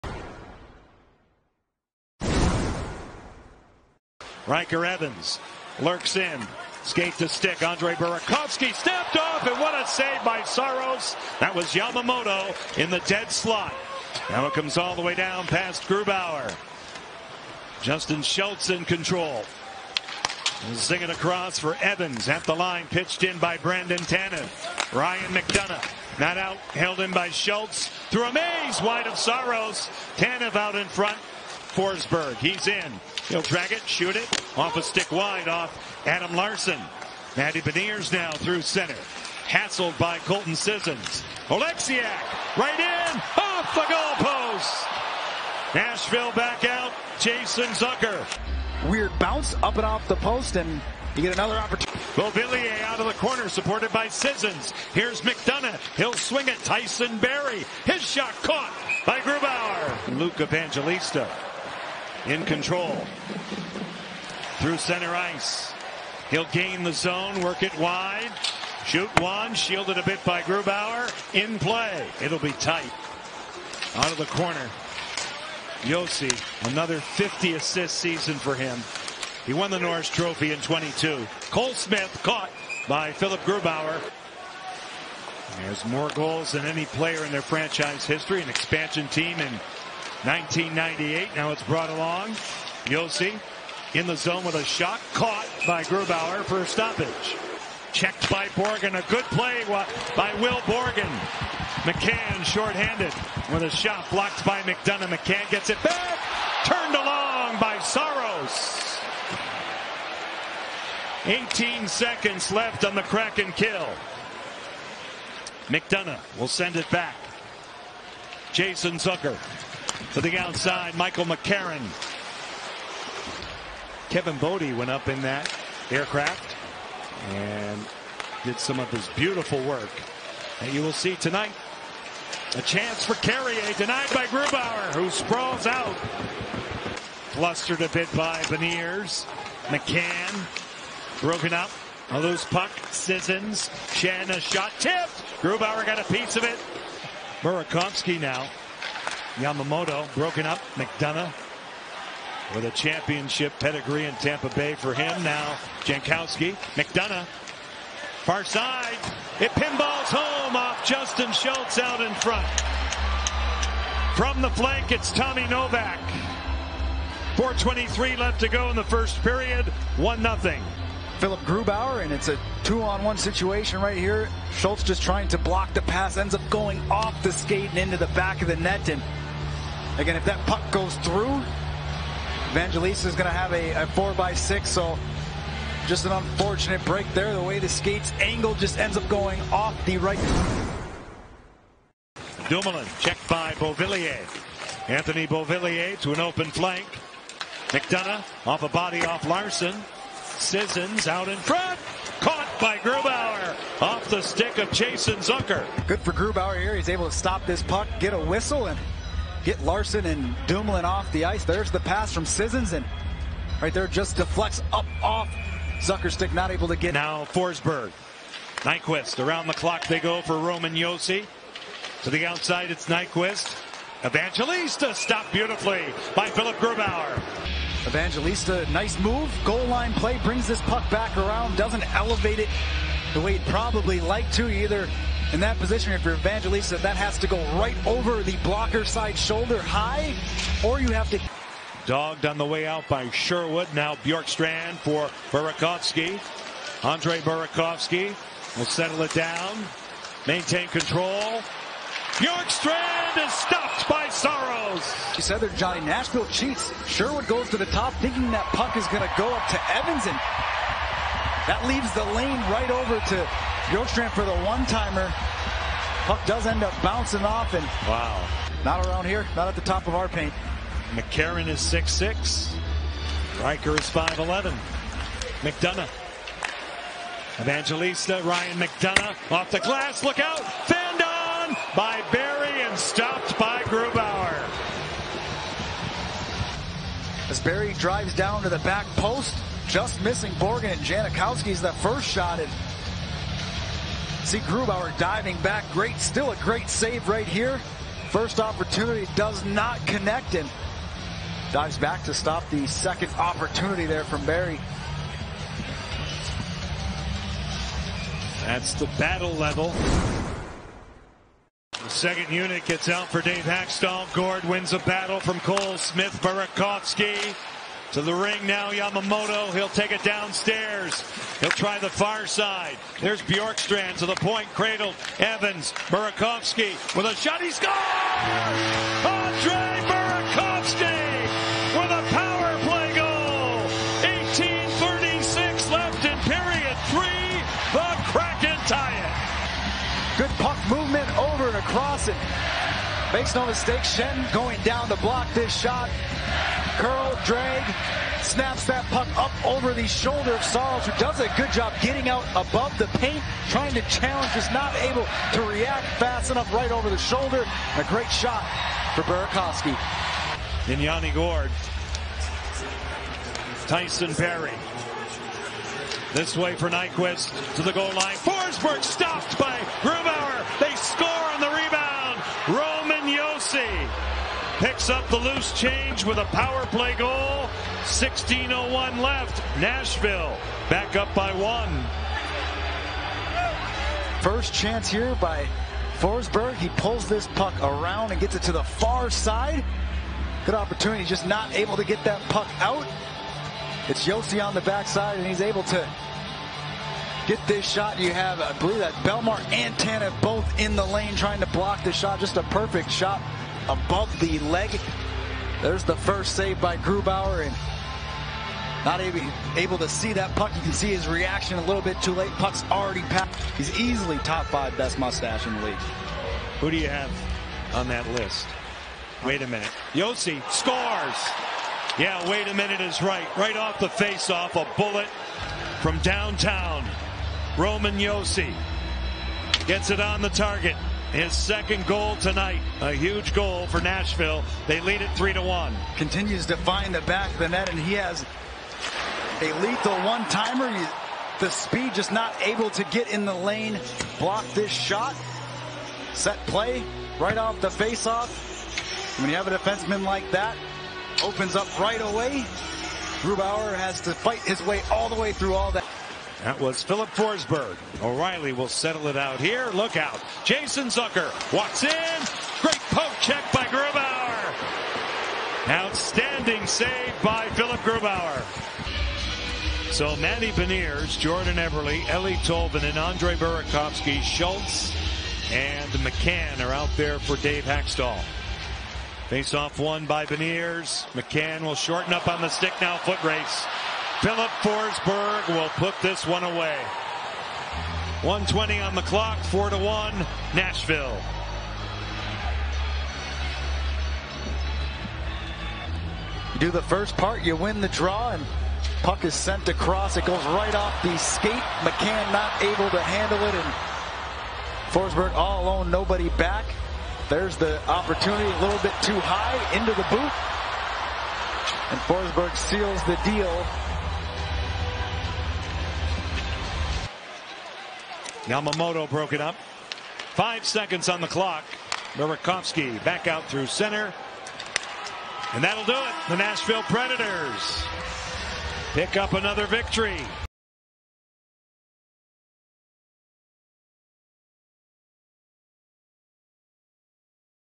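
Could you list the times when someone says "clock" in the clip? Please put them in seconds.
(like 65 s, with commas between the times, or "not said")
219 s, 489 s, 521 s.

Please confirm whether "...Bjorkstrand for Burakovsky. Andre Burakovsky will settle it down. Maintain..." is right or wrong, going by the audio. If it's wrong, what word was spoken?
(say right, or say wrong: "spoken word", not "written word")
right.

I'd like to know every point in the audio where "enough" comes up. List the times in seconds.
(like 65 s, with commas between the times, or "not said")
356 s.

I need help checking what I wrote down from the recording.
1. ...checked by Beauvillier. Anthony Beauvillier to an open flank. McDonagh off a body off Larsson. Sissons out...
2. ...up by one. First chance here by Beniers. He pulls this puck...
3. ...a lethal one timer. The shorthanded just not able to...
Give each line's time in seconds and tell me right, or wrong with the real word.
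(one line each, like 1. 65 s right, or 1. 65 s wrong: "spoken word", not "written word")
1. 192 s right
2. 380 s wrong: "Forsberg", not "Beniers"
3. 439 s wrong: "speed", not "shorthanded".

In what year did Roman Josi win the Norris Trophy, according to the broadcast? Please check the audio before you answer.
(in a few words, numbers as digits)
2022.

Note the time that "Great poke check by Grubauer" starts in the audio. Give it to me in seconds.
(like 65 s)
462 s.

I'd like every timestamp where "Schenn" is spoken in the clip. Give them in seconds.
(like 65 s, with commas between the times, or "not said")
343 s.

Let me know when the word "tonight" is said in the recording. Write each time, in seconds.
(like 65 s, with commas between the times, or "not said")
131 s, 432 s.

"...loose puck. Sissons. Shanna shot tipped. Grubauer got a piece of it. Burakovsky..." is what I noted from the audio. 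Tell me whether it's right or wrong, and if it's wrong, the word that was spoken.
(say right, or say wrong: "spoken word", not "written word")
right.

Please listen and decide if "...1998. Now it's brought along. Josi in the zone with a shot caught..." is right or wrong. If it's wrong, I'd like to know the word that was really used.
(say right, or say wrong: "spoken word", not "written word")
right.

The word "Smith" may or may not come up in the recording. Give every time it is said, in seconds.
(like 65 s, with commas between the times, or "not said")
81 s, 315 s.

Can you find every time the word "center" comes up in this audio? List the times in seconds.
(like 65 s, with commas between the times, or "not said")
38 s, 64 s, 523 s.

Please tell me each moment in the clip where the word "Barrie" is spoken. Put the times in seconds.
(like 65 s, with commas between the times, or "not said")
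57 s, 282 s, 287 s, 304 s, 364 s.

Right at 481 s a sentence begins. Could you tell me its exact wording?
McCann will shorten up on the stick now.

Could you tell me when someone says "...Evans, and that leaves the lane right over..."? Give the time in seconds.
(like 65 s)
259 s.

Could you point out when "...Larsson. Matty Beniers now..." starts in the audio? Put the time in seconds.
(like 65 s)
36 s.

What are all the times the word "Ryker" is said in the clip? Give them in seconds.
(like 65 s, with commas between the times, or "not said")
4 s, 273 s.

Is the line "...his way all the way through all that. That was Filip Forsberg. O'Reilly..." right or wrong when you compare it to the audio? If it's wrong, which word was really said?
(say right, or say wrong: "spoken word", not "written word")
right.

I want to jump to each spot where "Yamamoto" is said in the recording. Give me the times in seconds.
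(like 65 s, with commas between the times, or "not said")
11 s, 149 s, 318 s, 518 s.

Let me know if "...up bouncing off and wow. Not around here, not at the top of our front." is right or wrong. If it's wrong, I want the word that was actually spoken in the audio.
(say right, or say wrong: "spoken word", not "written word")
wrong: "paint", not "front".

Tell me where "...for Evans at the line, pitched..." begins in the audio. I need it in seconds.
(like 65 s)
21 s.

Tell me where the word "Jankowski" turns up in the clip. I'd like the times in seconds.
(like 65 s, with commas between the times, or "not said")
155 s, 290 s.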